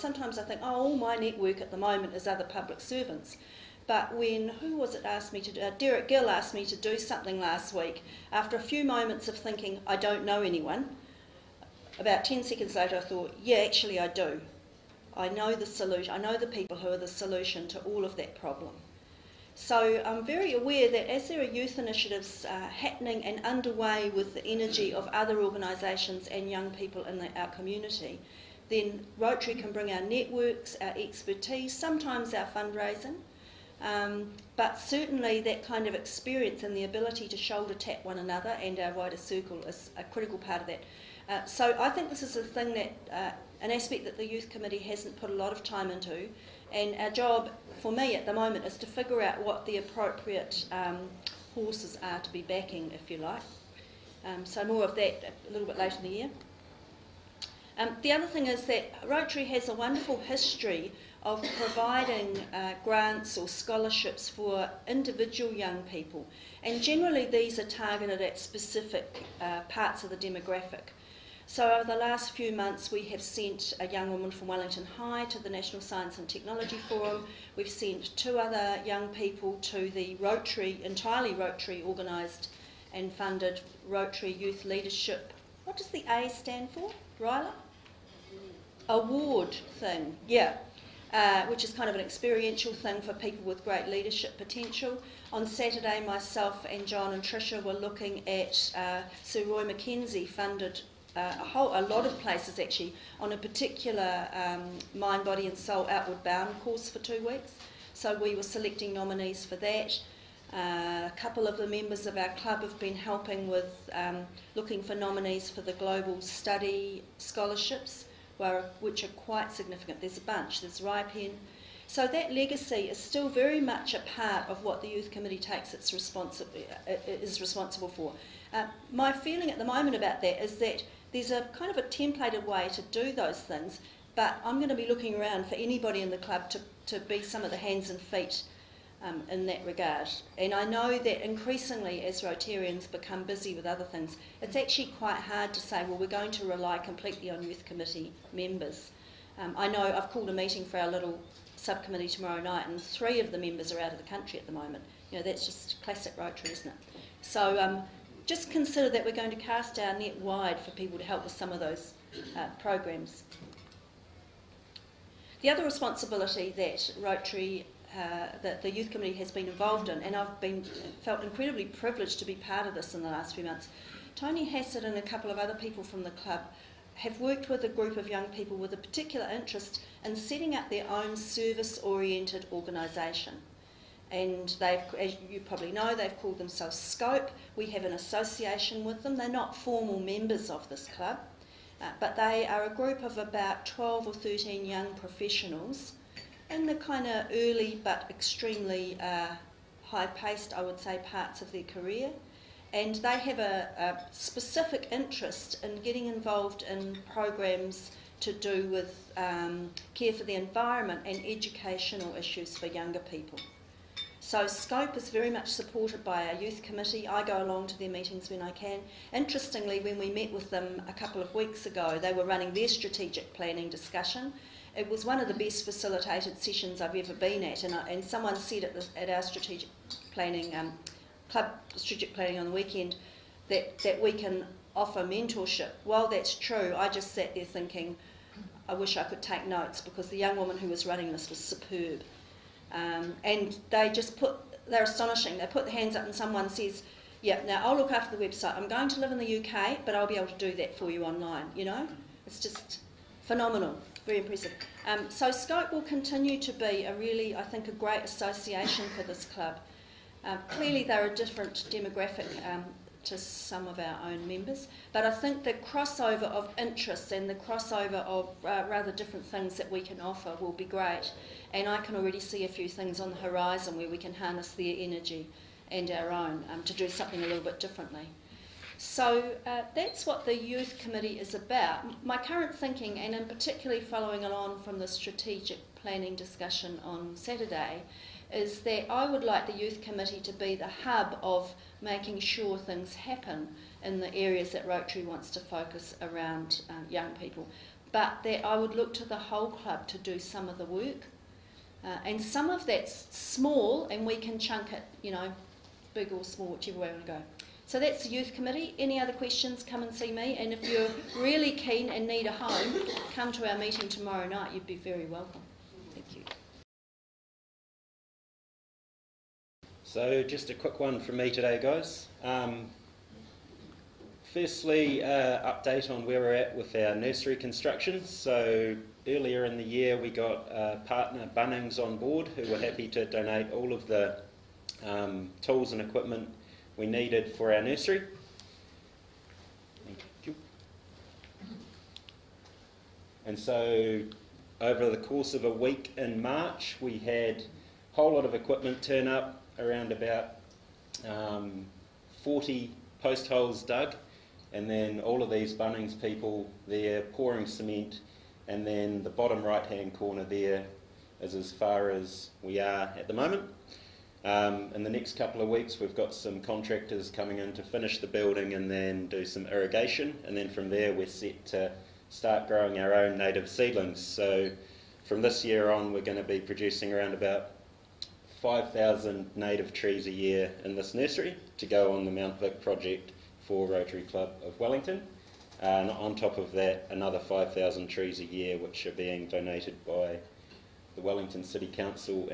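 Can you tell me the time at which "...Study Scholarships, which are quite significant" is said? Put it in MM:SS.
01:56.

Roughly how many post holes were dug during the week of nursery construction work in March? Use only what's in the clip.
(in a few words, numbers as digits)
40.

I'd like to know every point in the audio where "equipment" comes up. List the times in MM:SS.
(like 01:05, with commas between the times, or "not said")
05:35, 05:48.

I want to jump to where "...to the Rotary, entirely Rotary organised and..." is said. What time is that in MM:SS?
01:19.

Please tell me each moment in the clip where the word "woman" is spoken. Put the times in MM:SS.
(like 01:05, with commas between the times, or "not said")
01:14, 04:00.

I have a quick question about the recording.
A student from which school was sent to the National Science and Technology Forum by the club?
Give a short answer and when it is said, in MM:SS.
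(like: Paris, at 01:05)
Wellington High, at 01:14.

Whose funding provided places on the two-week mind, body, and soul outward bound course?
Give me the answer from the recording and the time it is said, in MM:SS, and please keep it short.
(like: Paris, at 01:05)
Sir Roy McKenzie, at 01:39.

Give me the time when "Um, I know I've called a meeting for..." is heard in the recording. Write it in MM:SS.
02:29.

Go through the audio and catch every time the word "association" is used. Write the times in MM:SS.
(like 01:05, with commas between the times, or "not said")
03:07, 04:18.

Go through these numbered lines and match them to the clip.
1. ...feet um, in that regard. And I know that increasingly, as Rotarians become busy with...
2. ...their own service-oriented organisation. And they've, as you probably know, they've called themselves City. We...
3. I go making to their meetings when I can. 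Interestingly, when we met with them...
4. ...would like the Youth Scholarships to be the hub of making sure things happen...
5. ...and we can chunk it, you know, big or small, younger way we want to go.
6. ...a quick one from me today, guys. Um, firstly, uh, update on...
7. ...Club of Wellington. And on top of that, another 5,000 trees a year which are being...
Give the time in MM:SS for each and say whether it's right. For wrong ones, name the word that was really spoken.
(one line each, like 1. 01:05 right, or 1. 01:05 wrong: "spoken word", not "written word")
1. 02:17 right
2. 03:00 wrong: "Scope", not "City"
3. 03:37 wrong: "along", not "making"
4. 04:49 wrong: "Committee", not "Scholarships"
5. 05:03 wrong: "whichever", not "younger"
6. 05:20 right
7. 06:24 right.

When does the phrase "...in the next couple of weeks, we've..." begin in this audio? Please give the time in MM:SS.
06:04.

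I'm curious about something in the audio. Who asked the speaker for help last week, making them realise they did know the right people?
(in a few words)
Derek Gill.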